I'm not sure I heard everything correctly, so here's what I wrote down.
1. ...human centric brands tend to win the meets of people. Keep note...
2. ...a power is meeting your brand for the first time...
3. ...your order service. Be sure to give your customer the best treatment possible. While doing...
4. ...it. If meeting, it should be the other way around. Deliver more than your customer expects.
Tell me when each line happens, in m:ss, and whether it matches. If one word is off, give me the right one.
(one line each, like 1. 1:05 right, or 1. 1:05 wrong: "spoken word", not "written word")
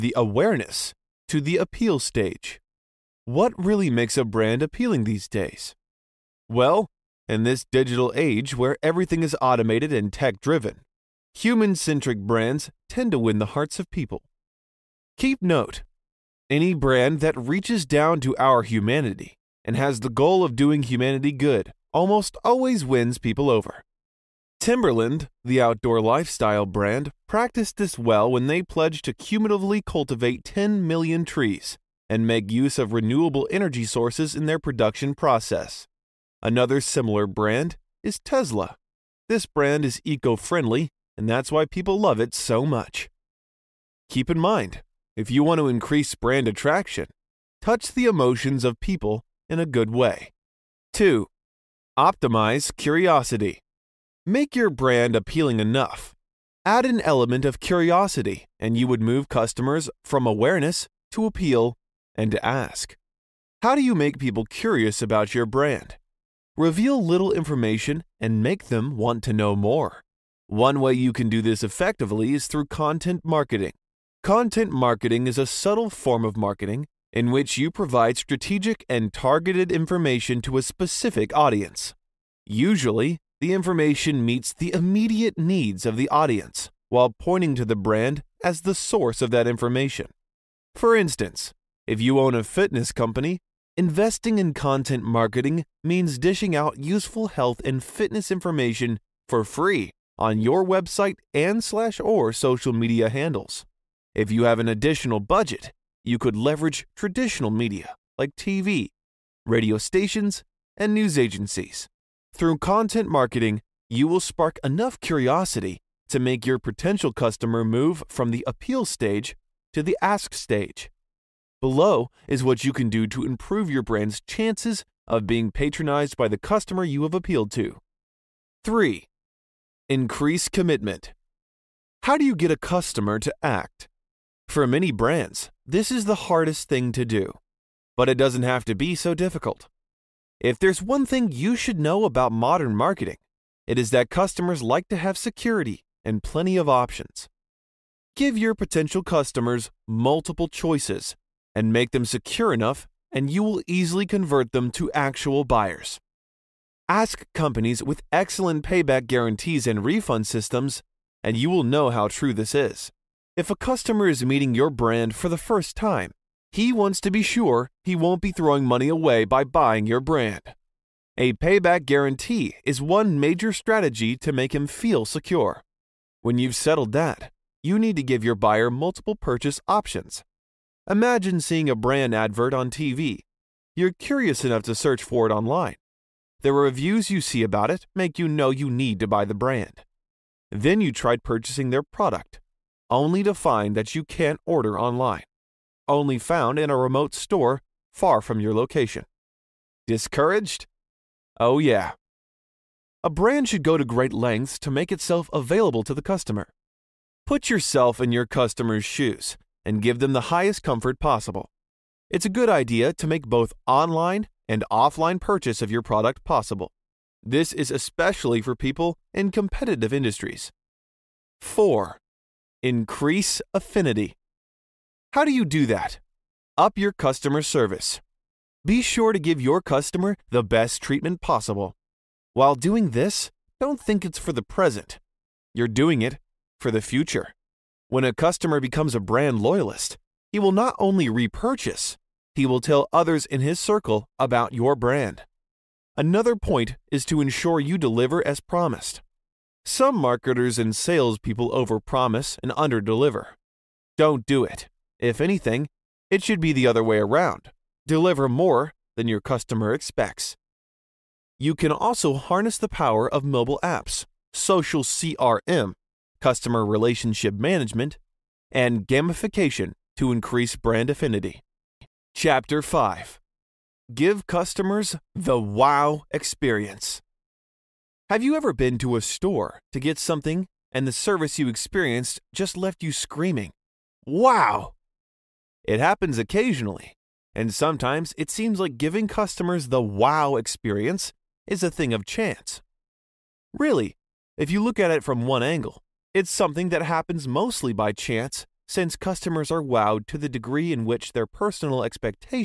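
1. 0:11 wrong: "hearts", not "meets"
2. 2:43 wrong: "customer", not "power"
3. 3:46 wrong: "customer", not "order"
4. 4:14 wrong: "anything", not "meeting".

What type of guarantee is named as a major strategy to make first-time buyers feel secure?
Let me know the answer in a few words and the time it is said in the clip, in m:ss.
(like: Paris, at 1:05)
Payback guarantee, at 2:51.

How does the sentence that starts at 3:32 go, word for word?
It's a good idea to make both online and offline purchase of your product possible.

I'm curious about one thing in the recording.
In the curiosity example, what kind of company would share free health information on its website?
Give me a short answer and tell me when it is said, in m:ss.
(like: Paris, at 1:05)
Fitness company, at 1:32.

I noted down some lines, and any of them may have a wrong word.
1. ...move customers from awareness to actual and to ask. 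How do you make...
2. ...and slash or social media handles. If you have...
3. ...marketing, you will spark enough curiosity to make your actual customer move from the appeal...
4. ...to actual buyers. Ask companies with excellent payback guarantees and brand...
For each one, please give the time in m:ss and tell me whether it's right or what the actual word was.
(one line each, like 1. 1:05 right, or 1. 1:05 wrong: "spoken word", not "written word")
1. 0:59 wrong: "appeal", not "actual"
2. 1:41 right
3. 1:53 wrong: "potential", not "actual"
4. 2:34 wrong: "refund", not "brand".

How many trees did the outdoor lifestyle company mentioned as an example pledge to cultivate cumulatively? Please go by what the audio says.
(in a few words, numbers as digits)
10 million.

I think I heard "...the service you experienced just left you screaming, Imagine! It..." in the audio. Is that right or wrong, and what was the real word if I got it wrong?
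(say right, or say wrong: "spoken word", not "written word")
wrong: "Wow", not "Imagine".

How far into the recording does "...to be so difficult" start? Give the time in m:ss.
2:18.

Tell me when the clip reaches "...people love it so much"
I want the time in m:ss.
0:41.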